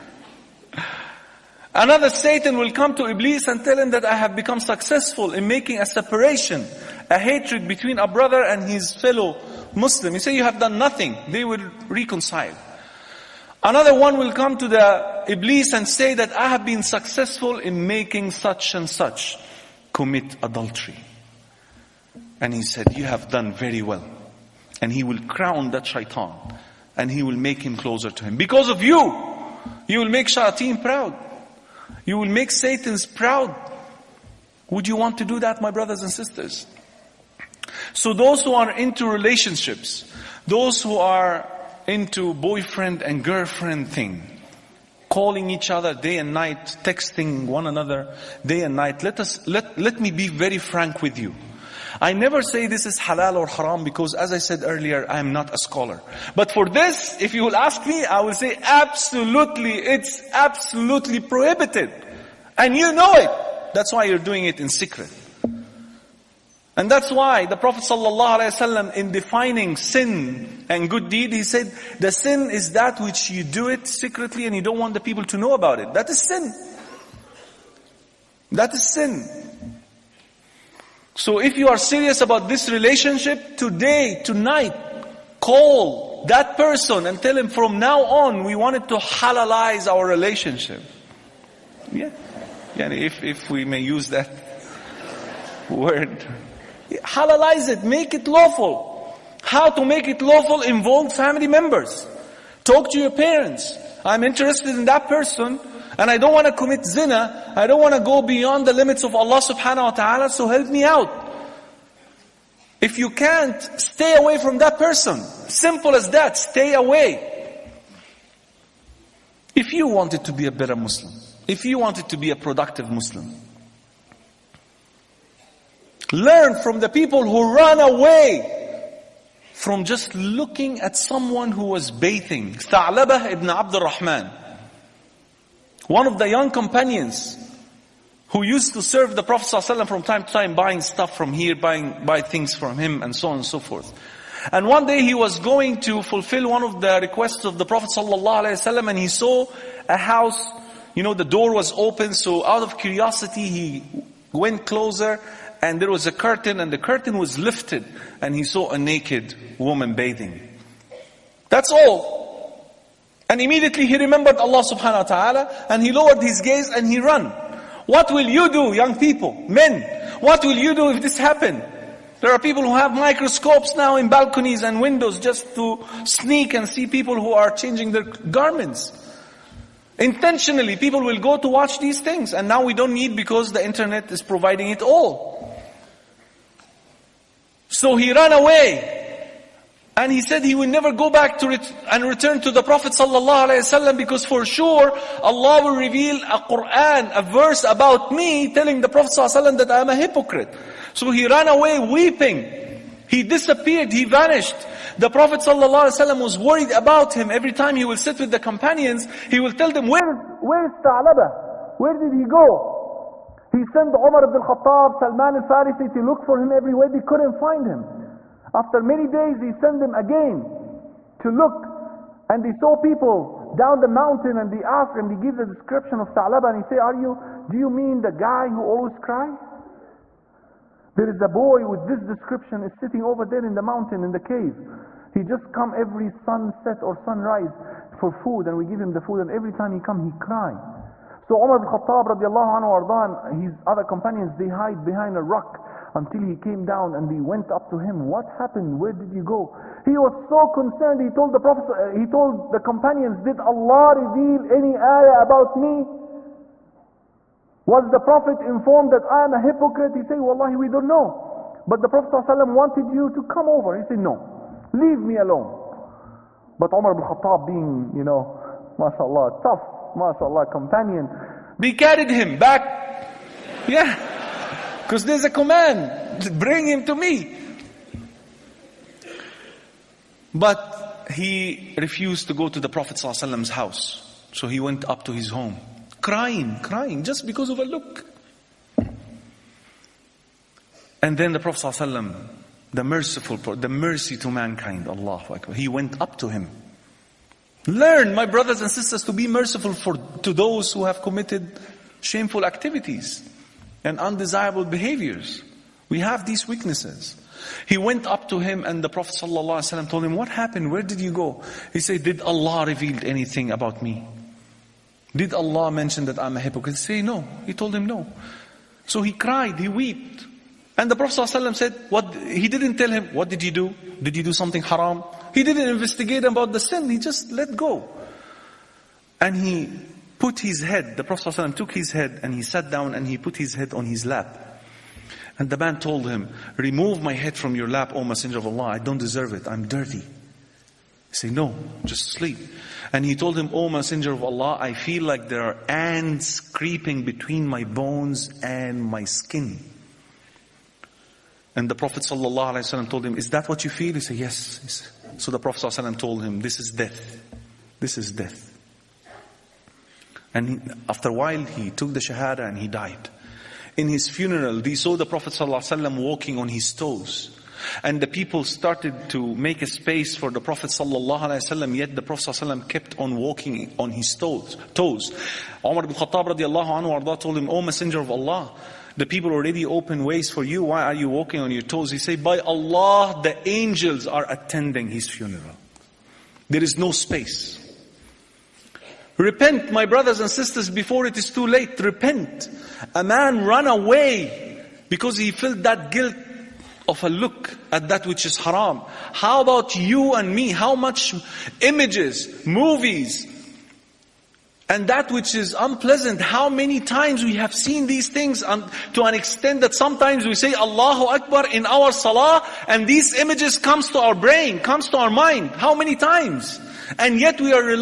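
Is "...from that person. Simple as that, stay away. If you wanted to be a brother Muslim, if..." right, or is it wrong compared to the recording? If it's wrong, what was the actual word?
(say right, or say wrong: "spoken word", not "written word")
wrong: "better", not "brother".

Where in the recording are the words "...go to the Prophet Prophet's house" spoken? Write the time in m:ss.
4:42.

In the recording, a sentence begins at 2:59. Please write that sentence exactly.
Intentionally, people will go to watch these things and now we don't need because the internet is providing it all.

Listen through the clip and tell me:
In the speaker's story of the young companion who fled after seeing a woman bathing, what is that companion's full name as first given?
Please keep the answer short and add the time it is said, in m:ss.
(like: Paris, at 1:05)
Tha'labah ibn Abdul Rahman, at 2:12.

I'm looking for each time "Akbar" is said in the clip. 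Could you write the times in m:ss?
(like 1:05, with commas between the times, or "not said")
4:55, 6:51.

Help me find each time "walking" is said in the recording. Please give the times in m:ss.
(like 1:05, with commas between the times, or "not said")
6:06, 6:13, 6:21.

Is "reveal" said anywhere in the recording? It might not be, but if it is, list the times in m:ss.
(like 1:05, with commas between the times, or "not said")
3:15, 4:14, 5:12.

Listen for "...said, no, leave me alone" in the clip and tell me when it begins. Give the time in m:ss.
4:23.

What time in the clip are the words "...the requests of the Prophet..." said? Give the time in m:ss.
2:26.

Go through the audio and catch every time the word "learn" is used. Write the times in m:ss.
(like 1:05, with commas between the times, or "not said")
2:06, 4:57.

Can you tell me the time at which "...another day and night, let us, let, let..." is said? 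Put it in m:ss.
0:47.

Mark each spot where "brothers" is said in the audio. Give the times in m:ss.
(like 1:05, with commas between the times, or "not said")
0:08, 0:35, 4:58, 6:29.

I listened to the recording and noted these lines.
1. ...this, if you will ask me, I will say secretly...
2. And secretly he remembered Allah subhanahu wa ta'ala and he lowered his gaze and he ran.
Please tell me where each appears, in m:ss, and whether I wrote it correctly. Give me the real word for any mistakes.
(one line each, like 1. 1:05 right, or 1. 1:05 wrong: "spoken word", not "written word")
1. 0:56 wrong: "absolutely", not "secretly"
2. 2:43 wrong: "immediately", not "secretly".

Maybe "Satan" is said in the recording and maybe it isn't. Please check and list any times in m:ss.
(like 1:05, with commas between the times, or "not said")
0:02, 0:32.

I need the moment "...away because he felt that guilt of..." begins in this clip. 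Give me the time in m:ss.
6:33.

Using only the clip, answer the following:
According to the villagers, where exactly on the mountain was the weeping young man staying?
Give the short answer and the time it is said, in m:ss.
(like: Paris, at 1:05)
In the cave, at 3:54.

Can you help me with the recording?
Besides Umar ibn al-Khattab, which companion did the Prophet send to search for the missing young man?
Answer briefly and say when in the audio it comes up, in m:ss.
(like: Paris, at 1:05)
Salman al-Farisi, at 3:34.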